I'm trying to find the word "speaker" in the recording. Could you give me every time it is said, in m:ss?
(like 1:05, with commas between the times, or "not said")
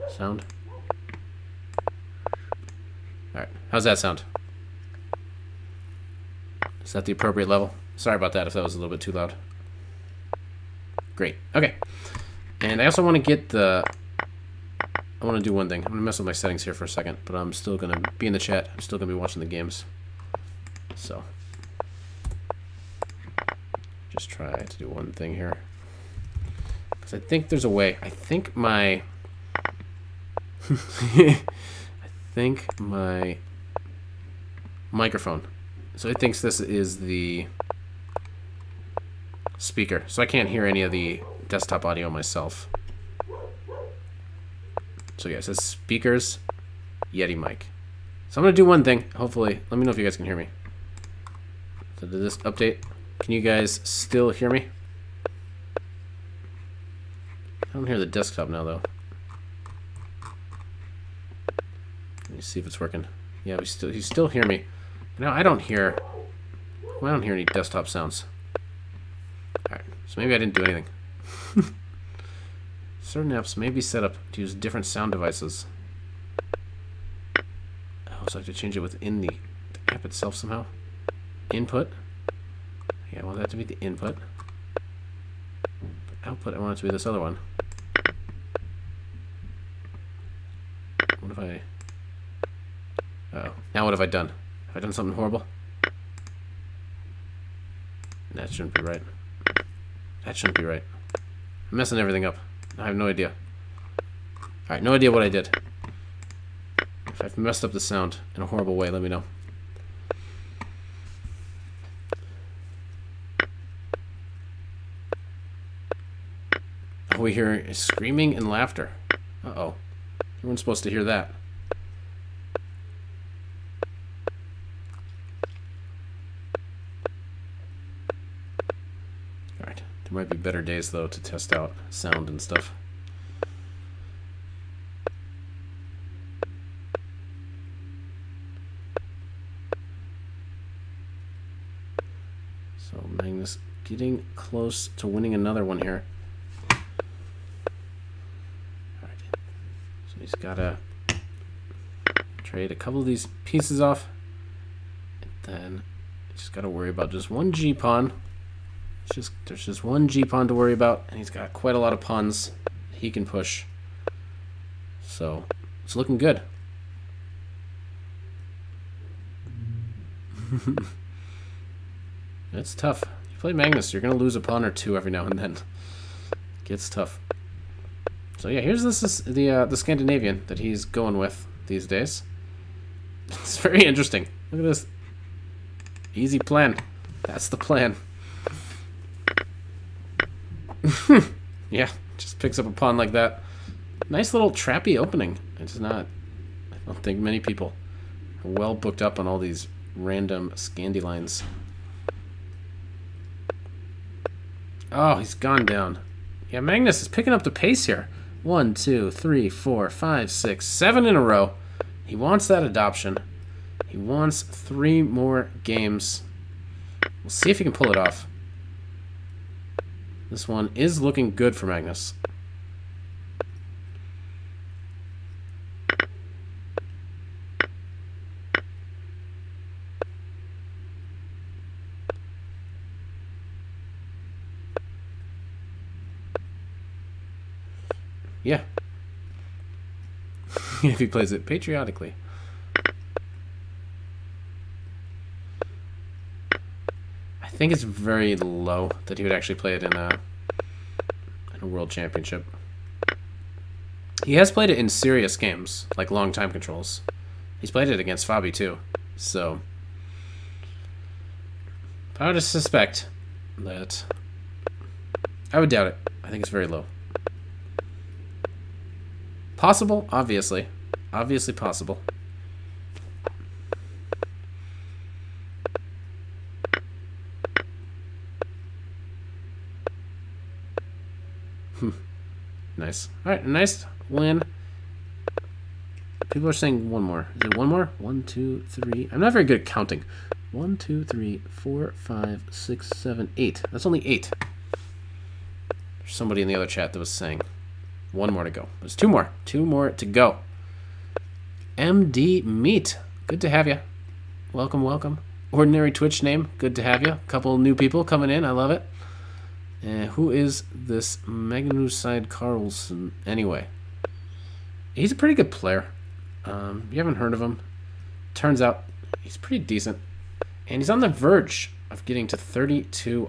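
0:39, 0:45.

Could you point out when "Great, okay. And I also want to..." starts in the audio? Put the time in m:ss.
0:11.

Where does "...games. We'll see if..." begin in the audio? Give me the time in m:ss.
3:35.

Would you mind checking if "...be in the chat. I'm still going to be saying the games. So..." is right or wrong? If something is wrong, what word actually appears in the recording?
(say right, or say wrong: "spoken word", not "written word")
wrong: "watching", not "saying".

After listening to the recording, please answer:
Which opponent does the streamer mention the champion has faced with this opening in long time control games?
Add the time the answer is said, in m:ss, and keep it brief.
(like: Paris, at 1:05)
Fabi, at 4:18.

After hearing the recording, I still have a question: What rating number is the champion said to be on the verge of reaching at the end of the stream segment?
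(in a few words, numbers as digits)
3200.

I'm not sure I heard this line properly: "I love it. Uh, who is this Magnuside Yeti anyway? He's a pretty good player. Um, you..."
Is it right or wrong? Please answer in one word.
wrong.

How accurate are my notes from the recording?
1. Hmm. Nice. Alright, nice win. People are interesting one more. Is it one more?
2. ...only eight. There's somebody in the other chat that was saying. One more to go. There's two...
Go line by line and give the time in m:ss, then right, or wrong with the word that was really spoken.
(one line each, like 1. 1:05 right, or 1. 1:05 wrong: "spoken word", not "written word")
1. 4:41 wrong: "saying", not "interesting"
2. 4:53 right.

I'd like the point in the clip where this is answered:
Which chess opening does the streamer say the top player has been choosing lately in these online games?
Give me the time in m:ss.
2:59.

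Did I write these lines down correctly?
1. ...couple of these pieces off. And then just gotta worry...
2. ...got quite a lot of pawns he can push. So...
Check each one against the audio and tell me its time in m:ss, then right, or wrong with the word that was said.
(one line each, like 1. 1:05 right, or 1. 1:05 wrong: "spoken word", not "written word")
1. 2:32 right
2. 2:41 right.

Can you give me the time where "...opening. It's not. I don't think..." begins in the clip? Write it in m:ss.
3:14.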